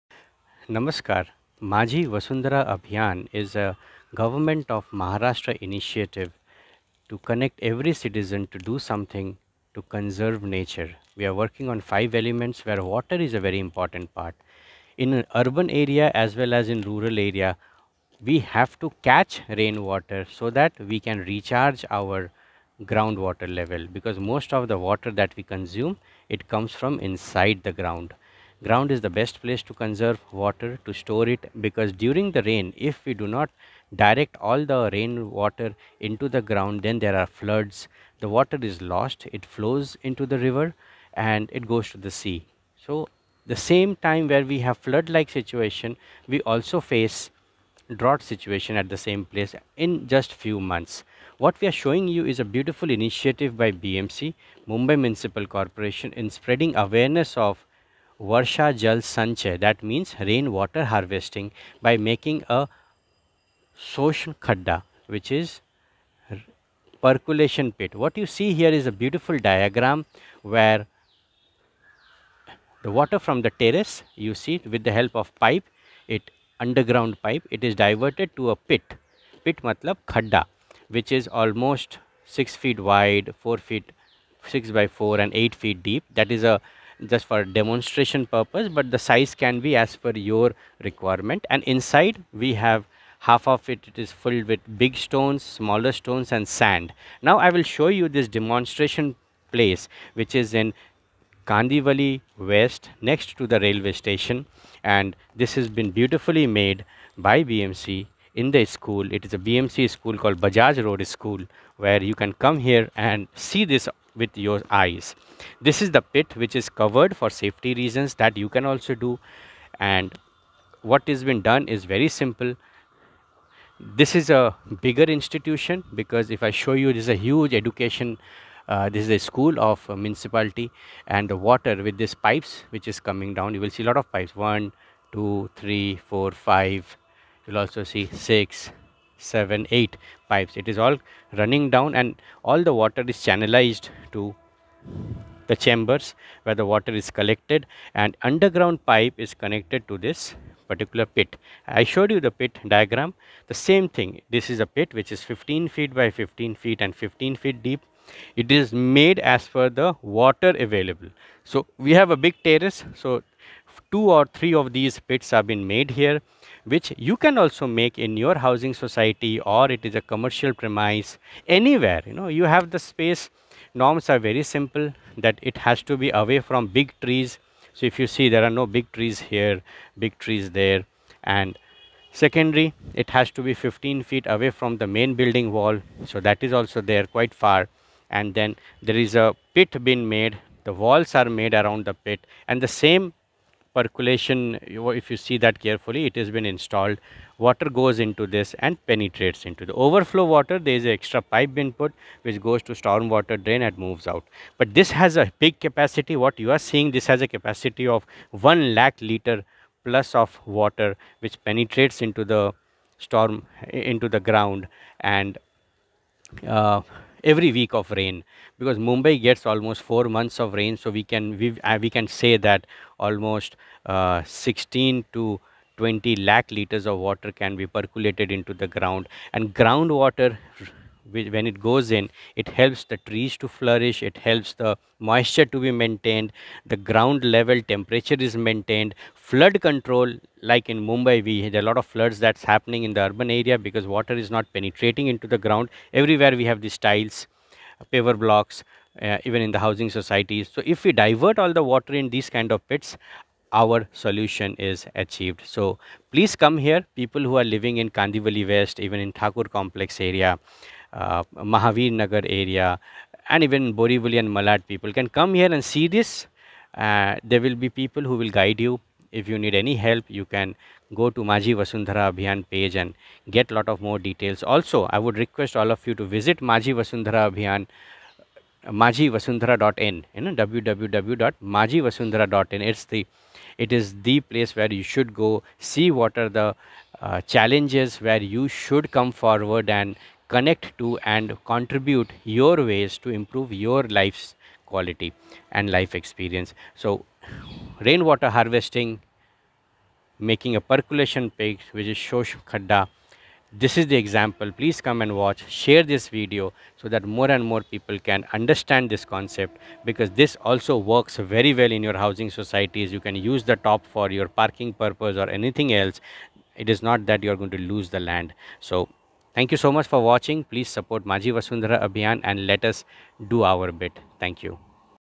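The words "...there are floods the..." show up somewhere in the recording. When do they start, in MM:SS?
00:36.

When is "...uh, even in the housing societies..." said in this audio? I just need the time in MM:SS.
04:08.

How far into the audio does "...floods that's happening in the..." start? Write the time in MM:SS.
04:01.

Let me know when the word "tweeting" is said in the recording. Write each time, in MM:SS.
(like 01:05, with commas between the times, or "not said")
not said.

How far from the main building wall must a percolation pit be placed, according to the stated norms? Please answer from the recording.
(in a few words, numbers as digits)
15 feet.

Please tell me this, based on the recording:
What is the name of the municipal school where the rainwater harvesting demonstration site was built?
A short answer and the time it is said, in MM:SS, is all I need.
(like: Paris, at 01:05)
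Bajaj Road School, at 01:50.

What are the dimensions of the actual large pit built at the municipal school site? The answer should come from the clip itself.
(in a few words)
15 feet by 15 feet.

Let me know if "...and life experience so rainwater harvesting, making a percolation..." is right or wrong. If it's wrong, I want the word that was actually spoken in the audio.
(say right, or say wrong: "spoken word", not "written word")
right.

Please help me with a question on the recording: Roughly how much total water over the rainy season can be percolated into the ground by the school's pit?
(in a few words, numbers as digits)
16 to 20 lakh liters.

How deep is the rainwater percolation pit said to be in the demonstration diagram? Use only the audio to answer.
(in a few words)
8 feet.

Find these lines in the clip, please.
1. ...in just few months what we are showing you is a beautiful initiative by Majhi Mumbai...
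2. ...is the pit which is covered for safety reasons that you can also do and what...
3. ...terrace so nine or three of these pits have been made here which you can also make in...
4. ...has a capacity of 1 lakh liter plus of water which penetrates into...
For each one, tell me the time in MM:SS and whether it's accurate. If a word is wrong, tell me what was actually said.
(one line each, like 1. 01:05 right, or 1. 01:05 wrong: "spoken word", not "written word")
1. 00:49 wrong: "BMC", not "Majhi"
2. 01:55 right
3. 02:42 wrong: "two", not "nine"
4. 03:27 right.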